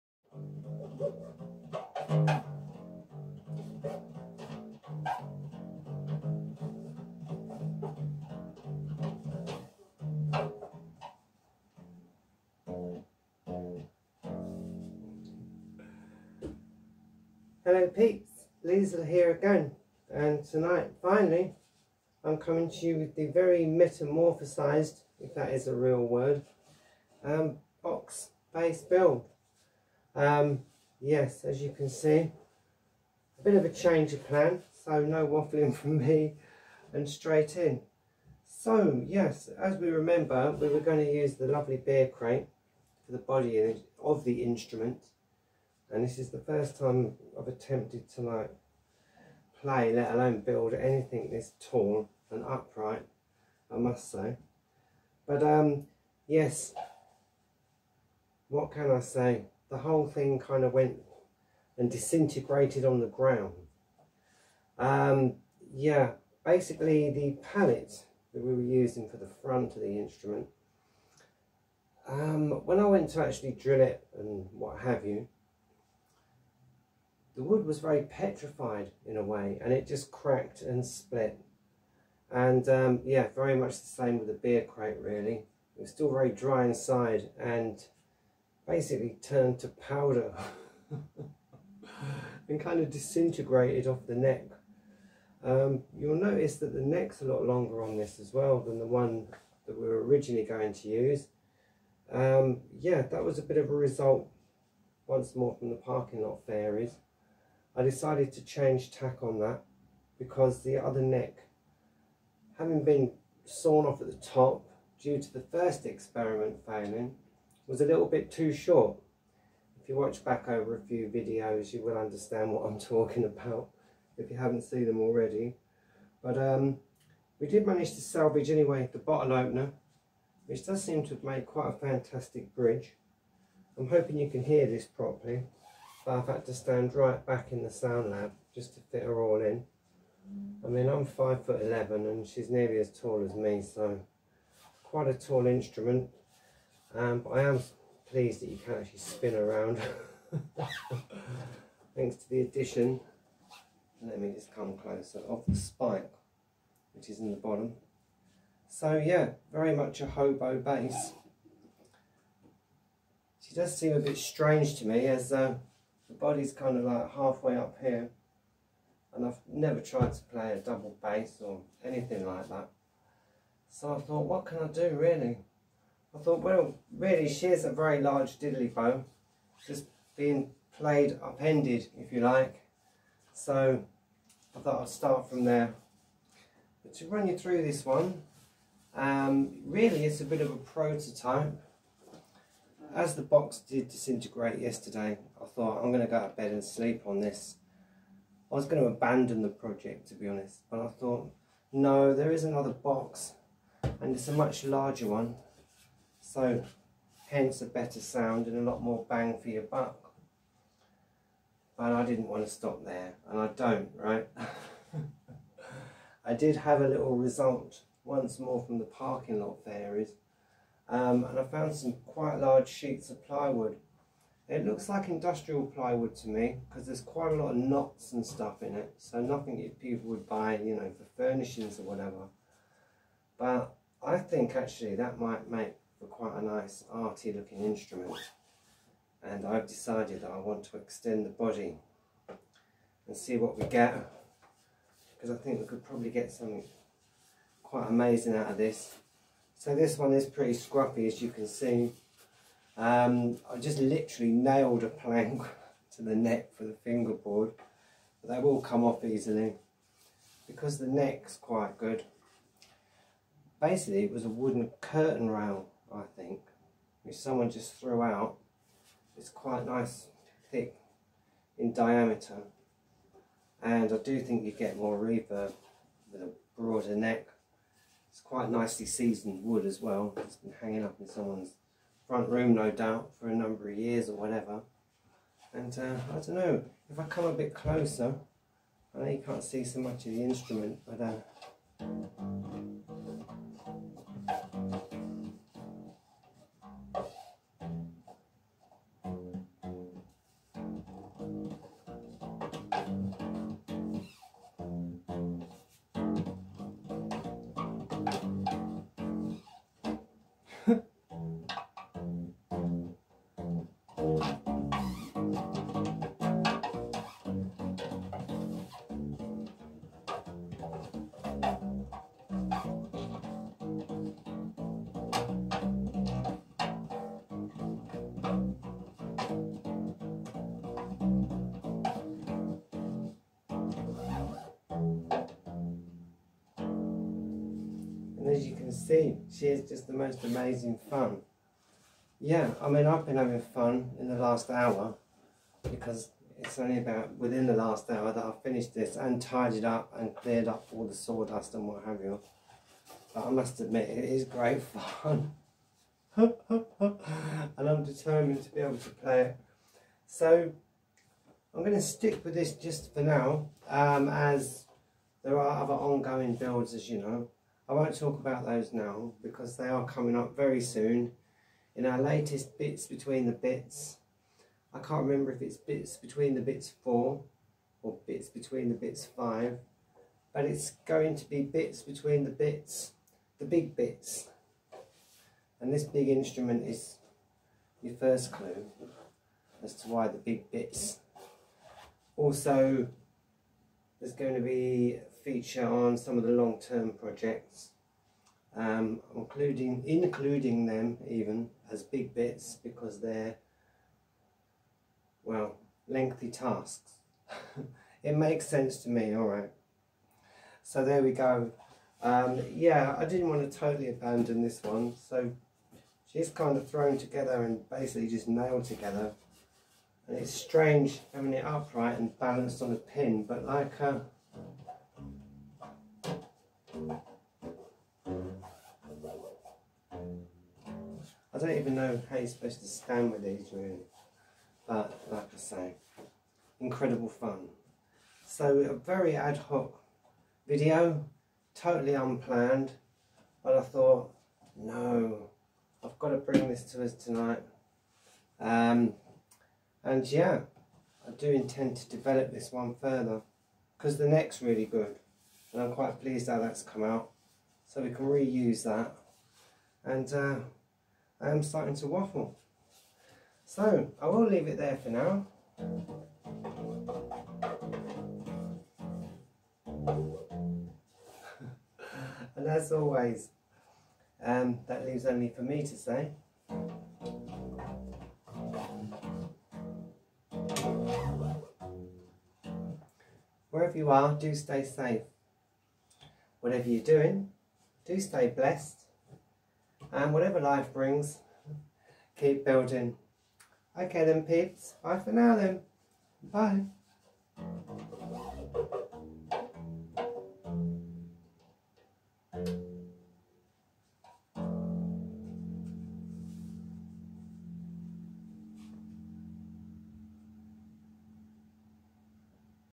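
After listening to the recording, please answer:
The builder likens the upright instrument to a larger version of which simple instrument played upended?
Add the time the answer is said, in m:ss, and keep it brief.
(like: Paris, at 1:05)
Diddly bow, at 2:58.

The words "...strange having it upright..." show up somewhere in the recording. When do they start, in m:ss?
7:00.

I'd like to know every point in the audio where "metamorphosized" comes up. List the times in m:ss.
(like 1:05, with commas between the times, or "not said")
0:23.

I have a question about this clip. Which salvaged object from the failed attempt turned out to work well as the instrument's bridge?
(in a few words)
Bottle opener.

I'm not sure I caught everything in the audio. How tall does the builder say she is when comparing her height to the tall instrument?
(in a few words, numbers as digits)
5 foot 11.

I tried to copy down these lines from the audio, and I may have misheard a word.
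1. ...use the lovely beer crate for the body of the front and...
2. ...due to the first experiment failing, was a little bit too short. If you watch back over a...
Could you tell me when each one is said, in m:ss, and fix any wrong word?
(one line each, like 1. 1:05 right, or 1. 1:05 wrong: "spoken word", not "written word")
1. 0:41 wrong: "instrument", not "front"
2. 1:54 right.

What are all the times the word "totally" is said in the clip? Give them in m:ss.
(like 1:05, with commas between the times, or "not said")
6:53, 7:21.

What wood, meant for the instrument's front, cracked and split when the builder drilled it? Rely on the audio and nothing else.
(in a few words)
Pallet.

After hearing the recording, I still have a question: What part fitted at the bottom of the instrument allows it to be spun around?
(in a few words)
Spike.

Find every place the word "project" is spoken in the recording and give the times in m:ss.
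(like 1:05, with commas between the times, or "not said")
3:19, 6:36.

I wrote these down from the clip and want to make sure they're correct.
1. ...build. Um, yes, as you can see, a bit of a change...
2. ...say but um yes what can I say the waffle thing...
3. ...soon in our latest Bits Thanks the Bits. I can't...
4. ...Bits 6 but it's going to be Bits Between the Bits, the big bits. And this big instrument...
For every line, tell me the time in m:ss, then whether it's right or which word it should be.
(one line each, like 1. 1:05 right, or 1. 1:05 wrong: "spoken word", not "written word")
1. 0:28 right
2. 0:54 wrong: "whole", not "waffle"
3. 6:10 wrong: "Between", not "Thanks"
4. 6:18 wrong: "5", not "6".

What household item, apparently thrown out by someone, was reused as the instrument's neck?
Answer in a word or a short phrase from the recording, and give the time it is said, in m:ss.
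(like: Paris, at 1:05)
Wooden curtain rail, at 4:24.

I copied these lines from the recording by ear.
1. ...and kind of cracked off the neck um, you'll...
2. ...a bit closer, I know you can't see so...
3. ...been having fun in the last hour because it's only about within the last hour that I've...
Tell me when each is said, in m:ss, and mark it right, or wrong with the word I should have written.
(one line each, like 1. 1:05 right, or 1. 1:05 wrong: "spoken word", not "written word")
1. 1:32 wrong: "disintegrated", not "cracked"
2. 4:47 right
3. 5:43 right.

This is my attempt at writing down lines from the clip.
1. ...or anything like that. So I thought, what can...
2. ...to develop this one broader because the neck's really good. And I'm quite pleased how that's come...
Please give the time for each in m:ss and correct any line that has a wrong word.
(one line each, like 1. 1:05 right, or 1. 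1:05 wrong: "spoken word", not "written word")
1. 2:51 right
2. 7:31 wrong: "further", not "broader".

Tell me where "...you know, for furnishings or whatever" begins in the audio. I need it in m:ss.
3:50.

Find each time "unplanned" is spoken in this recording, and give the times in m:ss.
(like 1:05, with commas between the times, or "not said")
7:21.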